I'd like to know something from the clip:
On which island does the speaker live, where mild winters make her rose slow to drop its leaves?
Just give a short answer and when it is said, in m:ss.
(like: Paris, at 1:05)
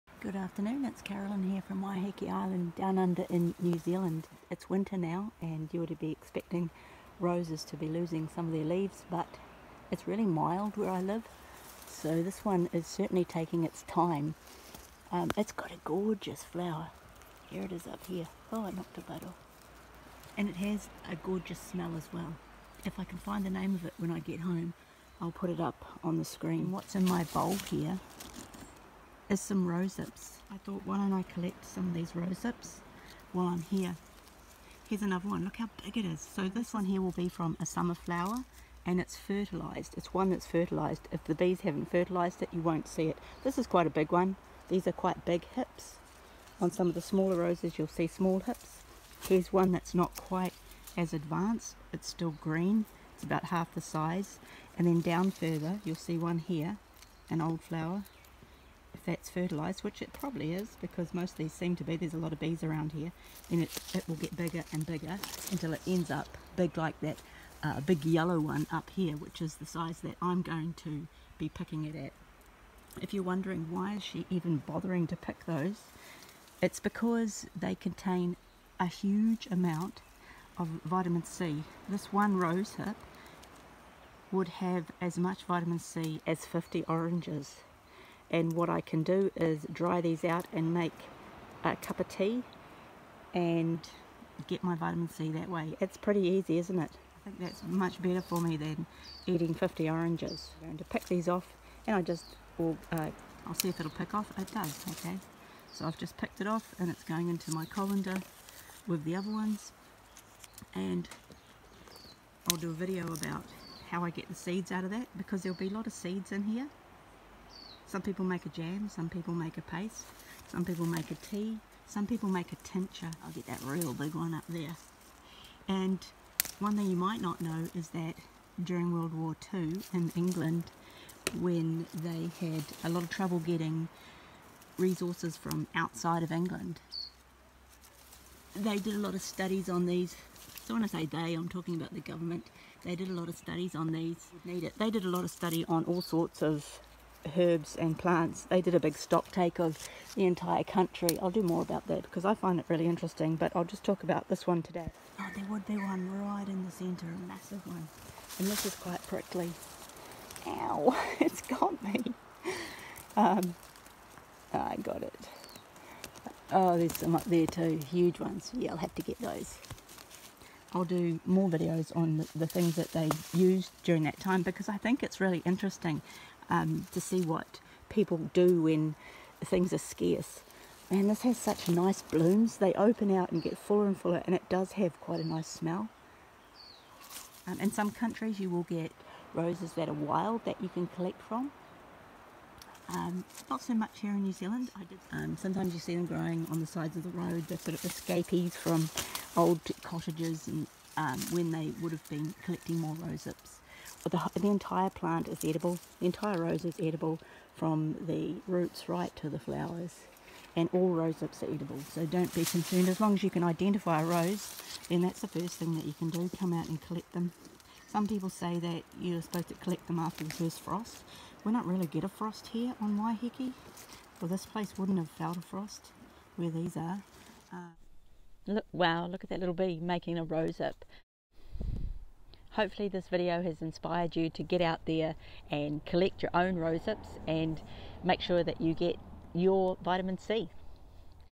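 Waiheke Island, at 0:01.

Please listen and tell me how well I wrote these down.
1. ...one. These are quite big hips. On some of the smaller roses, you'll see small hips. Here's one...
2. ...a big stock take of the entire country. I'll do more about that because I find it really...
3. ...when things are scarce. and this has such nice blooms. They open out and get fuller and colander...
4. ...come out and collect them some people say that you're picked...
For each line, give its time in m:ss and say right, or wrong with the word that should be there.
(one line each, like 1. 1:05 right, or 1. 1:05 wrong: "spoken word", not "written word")
1. 0:44 right
2. 2:28 right
3. 2:58 wrong: "fuller", not "colander"
4. 3:36 wrong: "supposed", not "picked".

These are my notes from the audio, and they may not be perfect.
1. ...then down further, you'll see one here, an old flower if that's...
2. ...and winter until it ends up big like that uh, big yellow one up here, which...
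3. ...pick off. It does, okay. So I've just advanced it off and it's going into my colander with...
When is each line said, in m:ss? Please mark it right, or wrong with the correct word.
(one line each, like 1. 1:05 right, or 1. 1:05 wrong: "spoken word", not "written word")
1. 0:54 right
2. 1:04 wrong: "bigger", not "winter"
3. 1:43 wrong: "picked", not "advanced".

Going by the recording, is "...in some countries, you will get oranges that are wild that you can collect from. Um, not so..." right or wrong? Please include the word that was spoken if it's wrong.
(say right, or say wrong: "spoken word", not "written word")
wrong: "roses", not "oranges".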